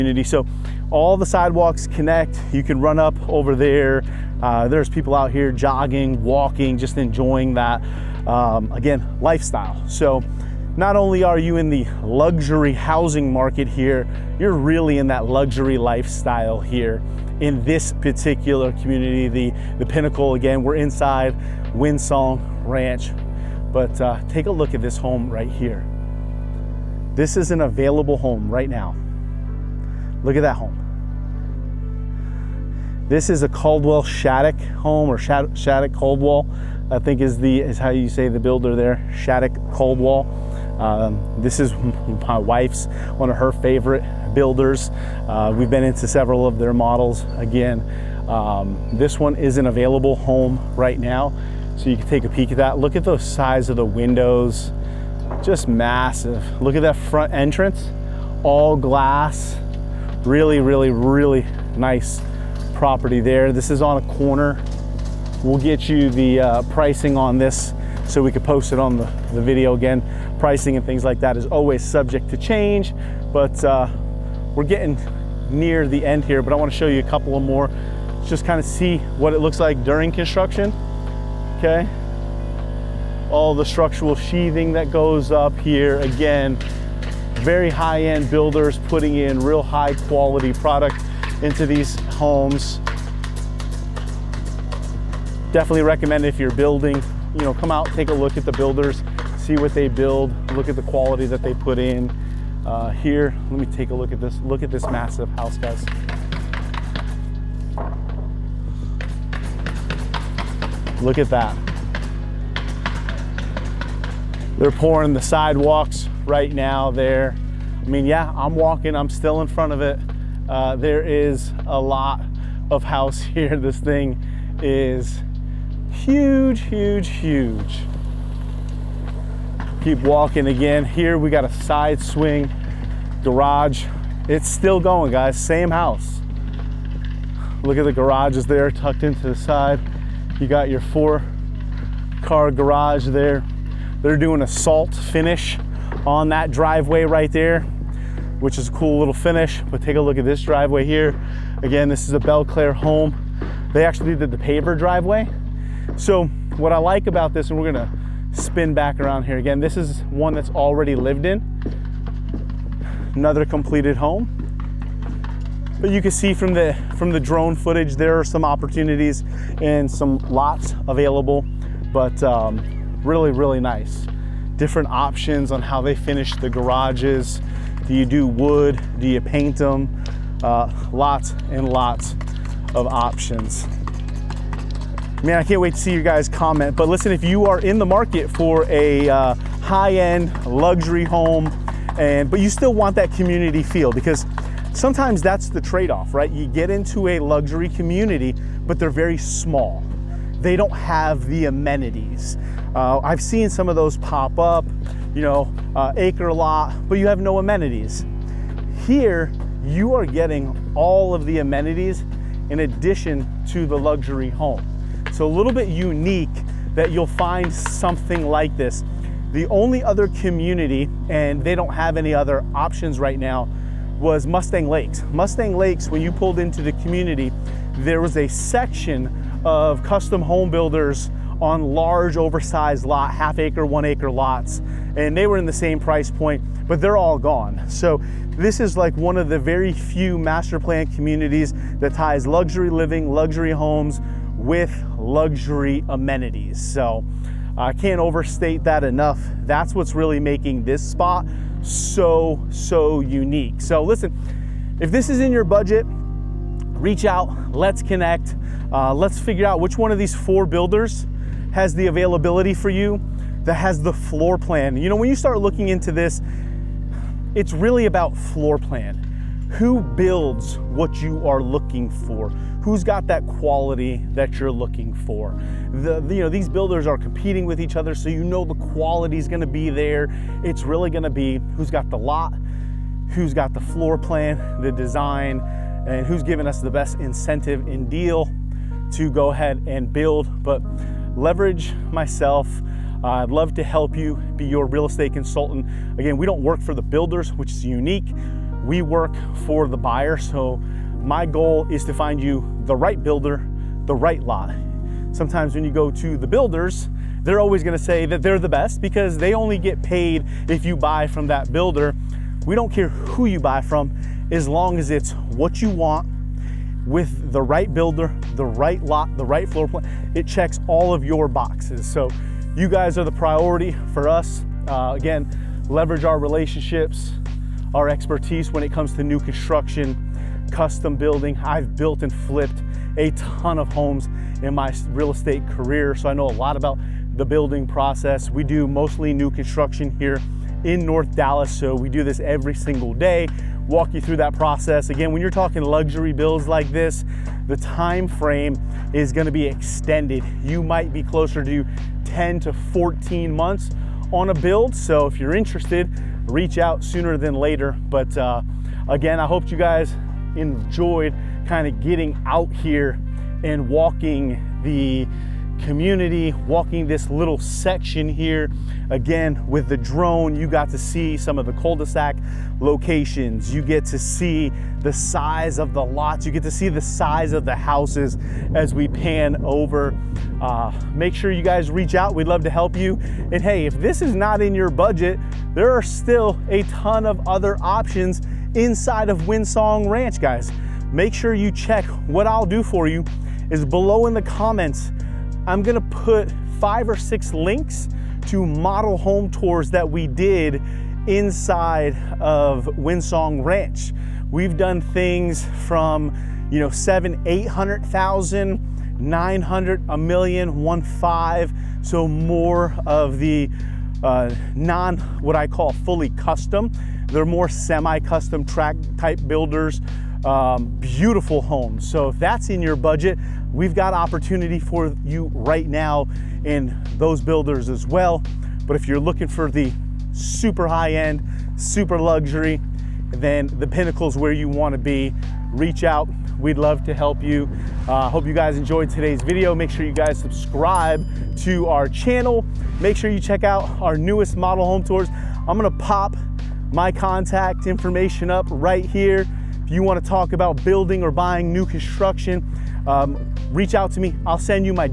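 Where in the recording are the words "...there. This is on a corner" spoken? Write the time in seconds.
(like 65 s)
63 s.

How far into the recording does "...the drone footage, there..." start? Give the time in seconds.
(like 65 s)
167 s.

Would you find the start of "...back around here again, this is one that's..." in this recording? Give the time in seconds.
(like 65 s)
158 s.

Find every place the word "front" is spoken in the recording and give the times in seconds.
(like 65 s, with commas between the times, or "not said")
56 s, 119 s.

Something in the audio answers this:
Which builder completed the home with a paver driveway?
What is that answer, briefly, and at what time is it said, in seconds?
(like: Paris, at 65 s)
Claire, at 152 s.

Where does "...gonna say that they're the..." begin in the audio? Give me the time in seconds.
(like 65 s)
307 s.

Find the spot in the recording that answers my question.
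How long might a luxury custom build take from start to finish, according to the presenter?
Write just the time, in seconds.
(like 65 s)
352 s.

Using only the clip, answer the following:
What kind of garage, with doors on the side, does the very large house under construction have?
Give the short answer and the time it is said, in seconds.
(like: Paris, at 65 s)
Side swing garage, at 131 s.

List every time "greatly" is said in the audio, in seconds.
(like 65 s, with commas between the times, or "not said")
not said.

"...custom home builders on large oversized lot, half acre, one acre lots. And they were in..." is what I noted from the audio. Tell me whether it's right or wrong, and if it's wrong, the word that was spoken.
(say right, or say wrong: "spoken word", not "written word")
right.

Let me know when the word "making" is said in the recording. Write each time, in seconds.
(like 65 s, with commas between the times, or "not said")
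250 s.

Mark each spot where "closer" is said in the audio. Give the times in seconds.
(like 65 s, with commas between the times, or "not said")
351 s.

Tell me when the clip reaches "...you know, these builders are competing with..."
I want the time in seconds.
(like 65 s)
276 s.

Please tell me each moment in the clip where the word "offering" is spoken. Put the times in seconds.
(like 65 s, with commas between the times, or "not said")
not said.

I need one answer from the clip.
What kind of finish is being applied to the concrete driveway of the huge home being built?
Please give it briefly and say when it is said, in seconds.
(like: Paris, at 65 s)
Salt finish, at 144 s.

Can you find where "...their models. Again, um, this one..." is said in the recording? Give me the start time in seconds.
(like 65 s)
46 s.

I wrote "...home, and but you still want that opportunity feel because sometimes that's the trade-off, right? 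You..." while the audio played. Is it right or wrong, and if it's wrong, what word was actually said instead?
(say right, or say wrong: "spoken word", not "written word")
wrong: "community", not "opportunity".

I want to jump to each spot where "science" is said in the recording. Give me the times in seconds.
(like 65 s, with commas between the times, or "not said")
not said.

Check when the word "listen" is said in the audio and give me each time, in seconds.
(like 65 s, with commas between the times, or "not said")
186 s, 253 s.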